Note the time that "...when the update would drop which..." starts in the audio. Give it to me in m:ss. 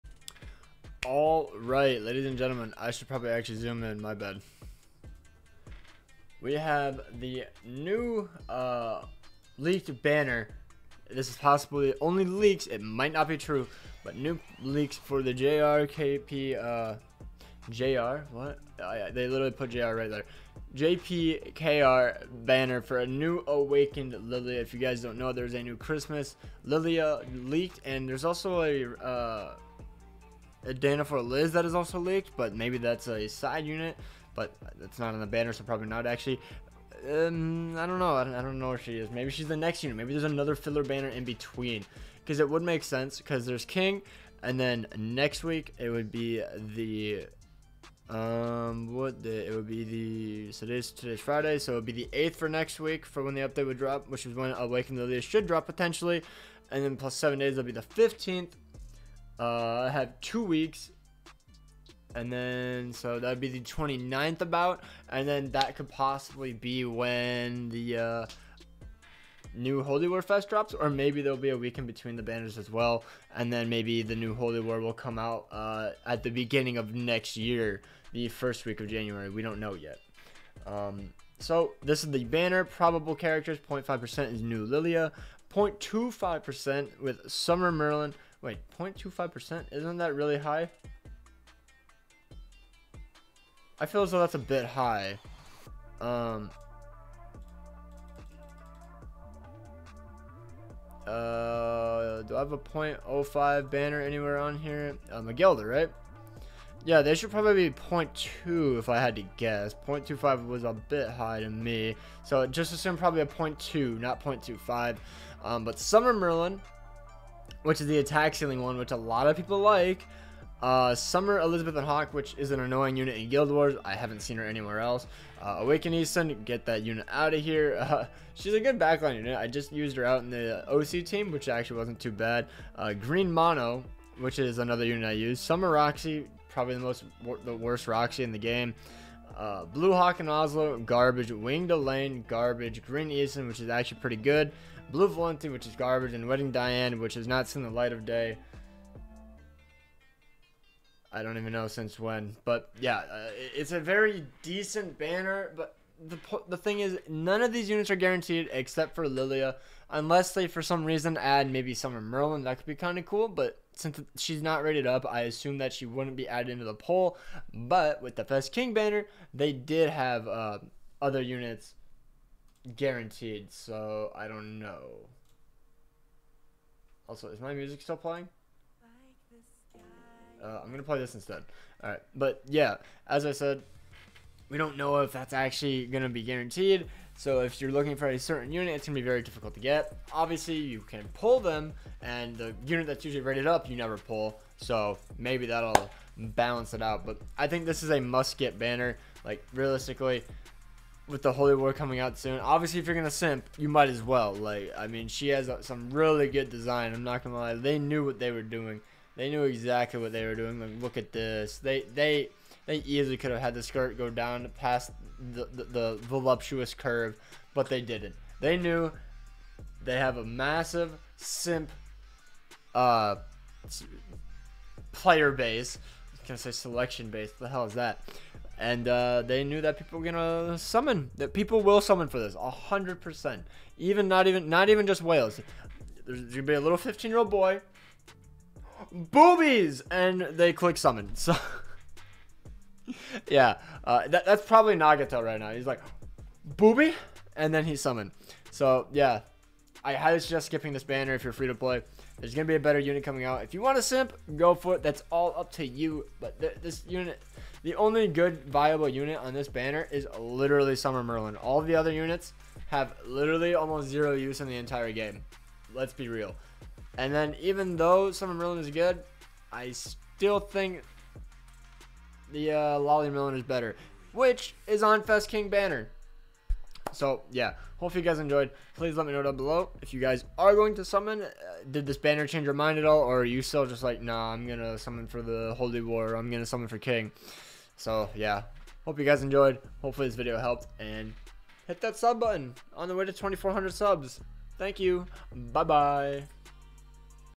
0:53.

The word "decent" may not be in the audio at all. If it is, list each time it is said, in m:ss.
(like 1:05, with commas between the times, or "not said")
2:34.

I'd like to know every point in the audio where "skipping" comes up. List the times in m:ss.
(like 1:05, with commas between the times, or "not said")
4:10.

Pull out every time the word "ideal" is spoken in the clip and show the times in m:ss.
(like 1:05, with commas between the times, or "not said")
not said.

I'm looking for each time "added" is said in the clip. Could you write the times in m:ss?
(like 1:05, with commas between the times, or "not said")
2:46.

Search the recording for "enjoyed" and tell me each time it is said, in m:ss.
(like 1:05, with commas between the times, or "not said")
4:38, 4:49.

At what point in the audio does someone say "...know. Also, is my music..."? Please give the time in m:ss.
2:54.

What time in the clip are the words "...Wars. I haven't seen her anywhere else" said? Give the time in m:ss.
2:03.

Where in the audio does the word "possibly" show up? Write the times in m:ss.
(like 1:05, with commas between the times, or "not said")
0:11, 1:05.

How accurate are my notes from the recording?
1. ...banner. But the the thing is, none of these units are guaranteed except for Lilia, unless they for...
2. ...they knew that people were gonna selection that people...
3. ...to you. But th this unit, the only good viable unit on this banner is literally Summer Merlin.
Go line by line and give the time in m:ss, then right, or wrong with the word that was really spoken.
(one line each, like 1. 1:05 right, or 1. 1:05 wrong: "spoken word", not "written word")
1. 2:34 right
2. 3:49 wrong: "summon", not "selection"
3. 4:15 right.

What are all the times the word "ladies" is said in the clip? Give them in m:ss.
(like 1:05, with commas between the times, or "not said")
0:02.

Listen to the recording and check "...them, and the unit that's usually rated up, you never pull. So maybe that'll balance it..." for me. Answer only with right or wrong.
right.